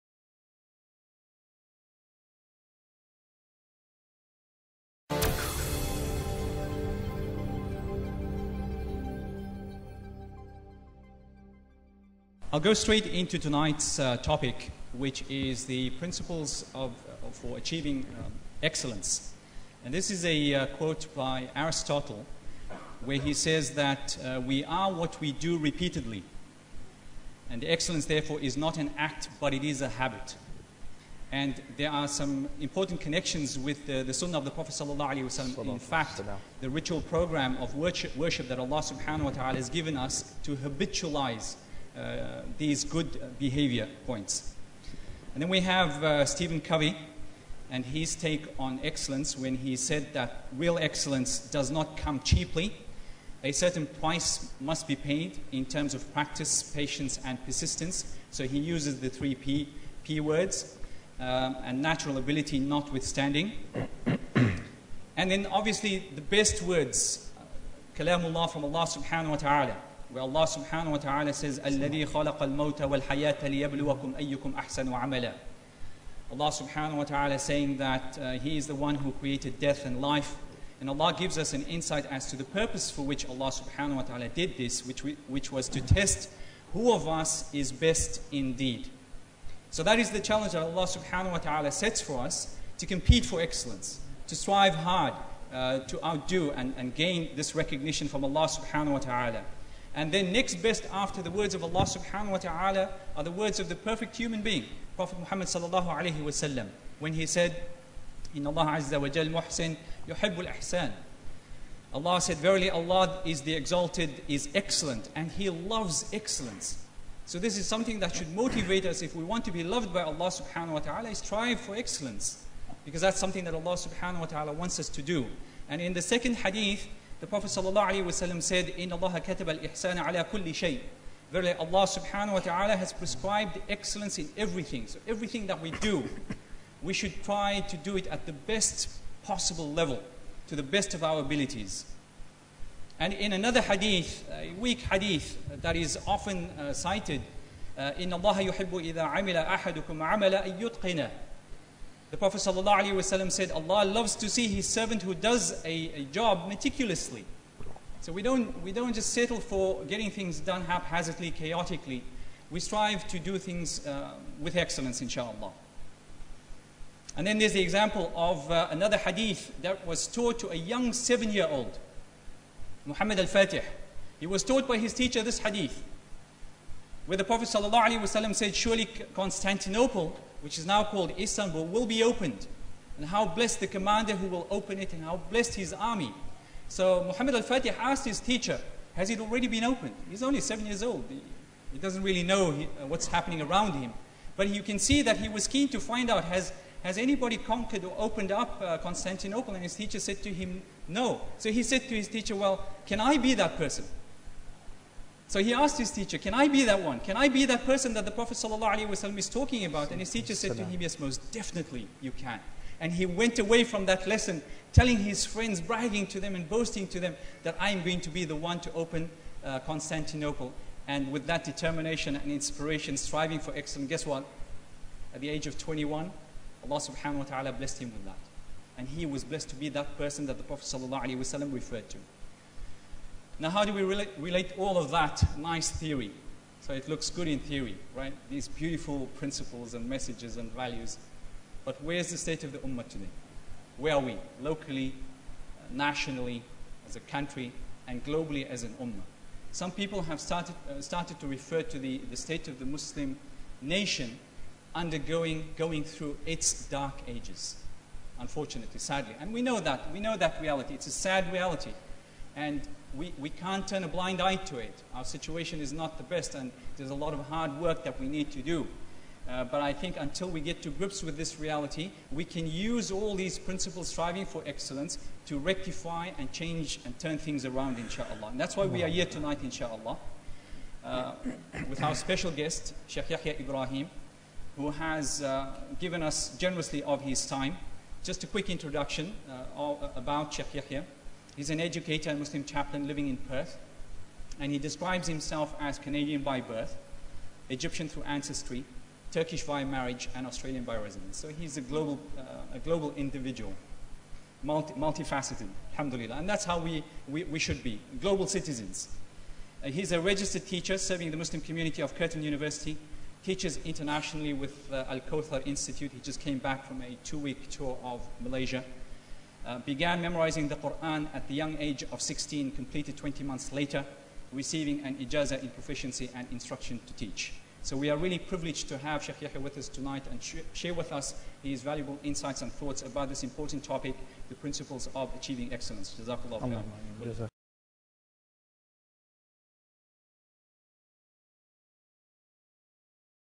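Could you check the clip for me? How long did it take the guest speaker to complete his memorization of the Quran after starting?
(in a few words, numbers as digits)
20 months.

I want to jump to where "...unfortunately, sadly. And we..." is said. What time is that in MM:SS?
04:18.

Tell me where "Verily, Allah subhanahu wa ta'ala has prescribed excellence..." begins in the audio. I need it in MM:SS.
02:11.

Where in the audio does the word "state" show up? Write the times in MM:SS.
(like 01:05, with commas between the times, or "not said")
04:02, 04:12.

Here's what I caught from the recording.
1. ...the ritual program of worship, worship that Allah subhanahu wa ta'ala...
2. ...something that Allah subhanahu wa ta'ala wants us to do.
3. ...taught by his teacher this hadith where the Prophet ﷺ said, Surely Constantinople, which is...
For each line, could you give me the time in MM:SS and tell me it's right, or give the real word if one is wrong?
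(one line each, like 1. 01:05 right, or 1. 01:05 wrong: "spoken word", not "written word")
1. 00:36 right
2. 02:03 right
3. 02:54 right.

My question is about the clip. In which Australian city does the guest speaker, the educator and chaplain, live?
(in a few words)
Perth.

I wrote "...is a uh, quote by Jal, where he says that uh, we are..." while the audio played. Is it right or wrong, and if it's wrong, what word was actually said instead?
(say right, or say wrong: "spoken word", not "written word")
wrong: "Aristotle", not "Jal".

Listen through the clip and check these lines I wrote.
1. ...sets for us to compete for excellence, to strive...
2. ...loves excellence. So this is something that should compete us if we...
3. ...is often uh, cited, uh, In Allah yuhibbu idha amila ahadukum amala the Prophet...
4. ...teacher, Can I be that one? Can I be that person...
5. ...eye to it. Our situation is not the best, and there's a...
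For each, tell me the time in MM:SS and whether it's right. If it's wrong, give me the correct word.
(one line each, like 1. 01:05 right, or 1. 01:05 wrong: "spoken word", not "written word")
1. 01:31 right
2. 01:55 wrong: "motivate", not "compete"
3. 02:25 right
4. 03:25 right
5. 04:24 right.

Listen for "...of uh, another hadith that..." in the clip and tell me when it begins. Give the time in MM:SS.
02:48.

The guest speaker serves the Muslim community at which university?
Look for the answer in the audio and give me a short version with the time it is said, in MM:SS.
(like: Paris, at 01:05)
Curtin University, at 05:11.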